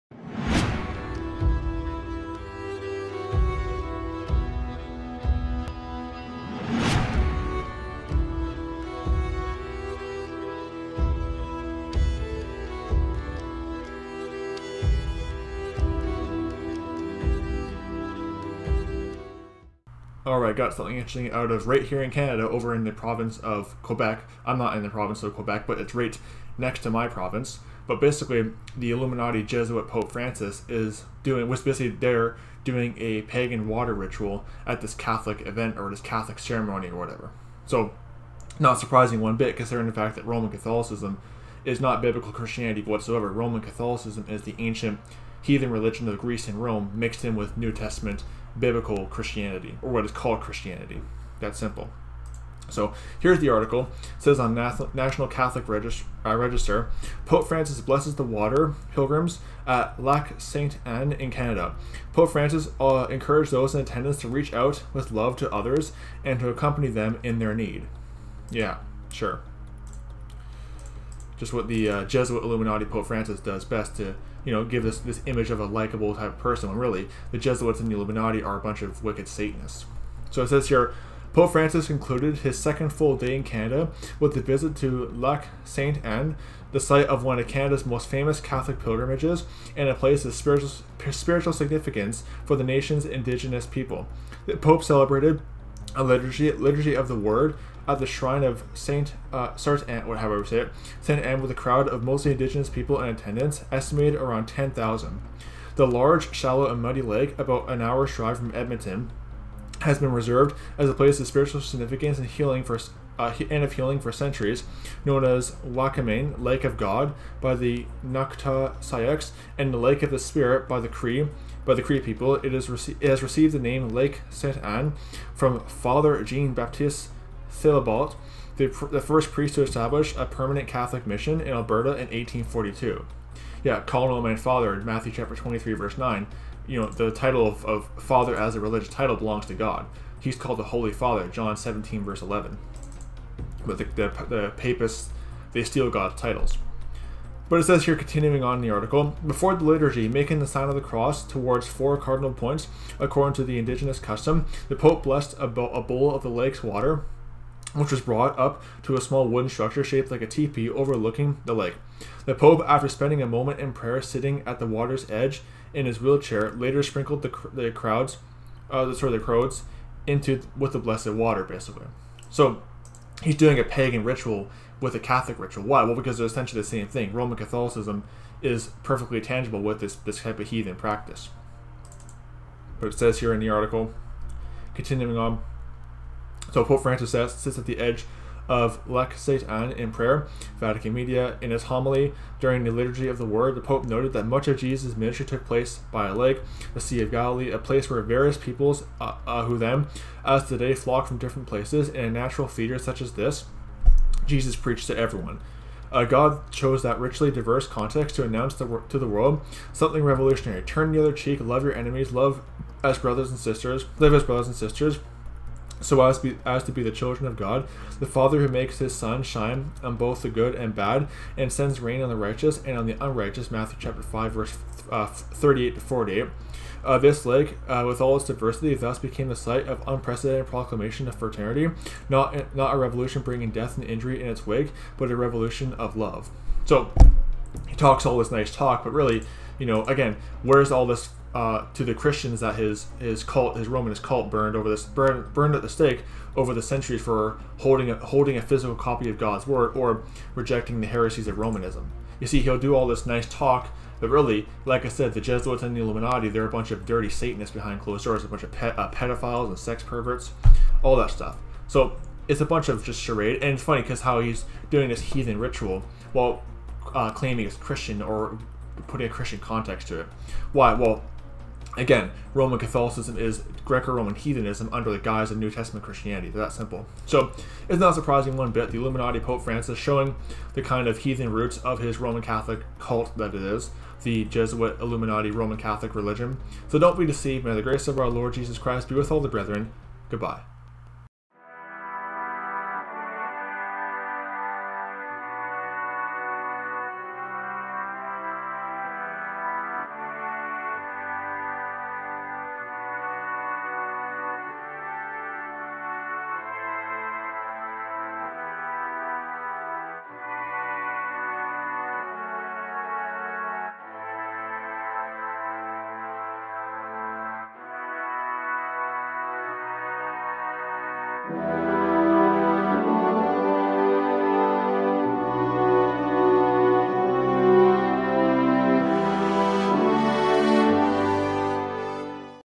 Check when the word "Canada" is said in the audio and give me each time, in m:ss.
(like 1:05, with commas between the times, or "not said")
0:22, 1:01, 1:23, 1:27.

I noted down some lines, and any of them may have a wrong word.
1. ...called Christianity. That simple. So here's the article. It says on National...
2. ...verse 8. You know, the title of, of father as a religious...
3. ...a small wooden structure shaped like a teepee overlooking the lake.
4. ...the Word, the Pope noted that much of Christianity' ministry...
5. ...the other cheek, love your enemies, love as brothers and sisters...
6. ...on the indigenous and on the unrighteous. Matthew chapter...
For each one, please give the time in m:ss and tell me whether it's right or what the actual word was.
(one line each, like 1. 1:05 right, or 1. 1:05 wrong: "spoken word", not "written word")
1. 0:50 right
2. 2:15 wrong: "9", not "8"
3. 2:38 right
4. 3:13 wrong: "Jesus", not "Christianity"
5. 3:30 right
6. 3:42 wrong: "righteous", not "indigenous".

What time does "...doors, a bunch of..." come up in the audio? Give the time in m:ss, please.
4:18.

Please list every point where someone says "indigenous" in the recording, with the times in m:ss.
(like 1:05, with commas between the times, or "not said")
1:33, 1:42, 2:33.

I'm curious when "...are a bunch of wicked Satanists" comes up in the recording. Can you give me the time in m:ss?
1:18.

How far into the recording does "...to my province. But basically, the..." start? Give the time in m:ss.
0:26.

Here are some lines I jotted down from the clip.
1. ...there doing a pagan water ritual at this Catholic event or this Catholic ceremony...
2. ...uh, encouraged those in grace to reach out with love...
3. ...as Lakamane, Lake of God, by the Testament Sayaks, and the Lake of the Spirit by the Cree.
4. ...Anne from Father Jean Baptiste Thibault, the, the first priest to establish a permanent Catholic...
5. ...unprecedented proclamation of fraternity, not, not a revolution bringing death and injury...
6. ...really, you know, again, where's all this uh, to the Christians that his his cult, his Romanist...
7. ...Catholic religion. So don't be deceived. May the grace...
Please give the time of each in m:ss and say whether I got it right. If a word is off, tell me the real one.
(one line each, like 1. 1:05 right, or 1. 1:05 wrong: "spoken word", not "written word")
1. 0:31 right
2. 1:02 wrong: "attendance", not "grace"
3. 1:55 wrong: "Nakota", not "Testament"
4. 2:04 right
5. 3:49 right
6. 3:58 right
7. 4:45 right.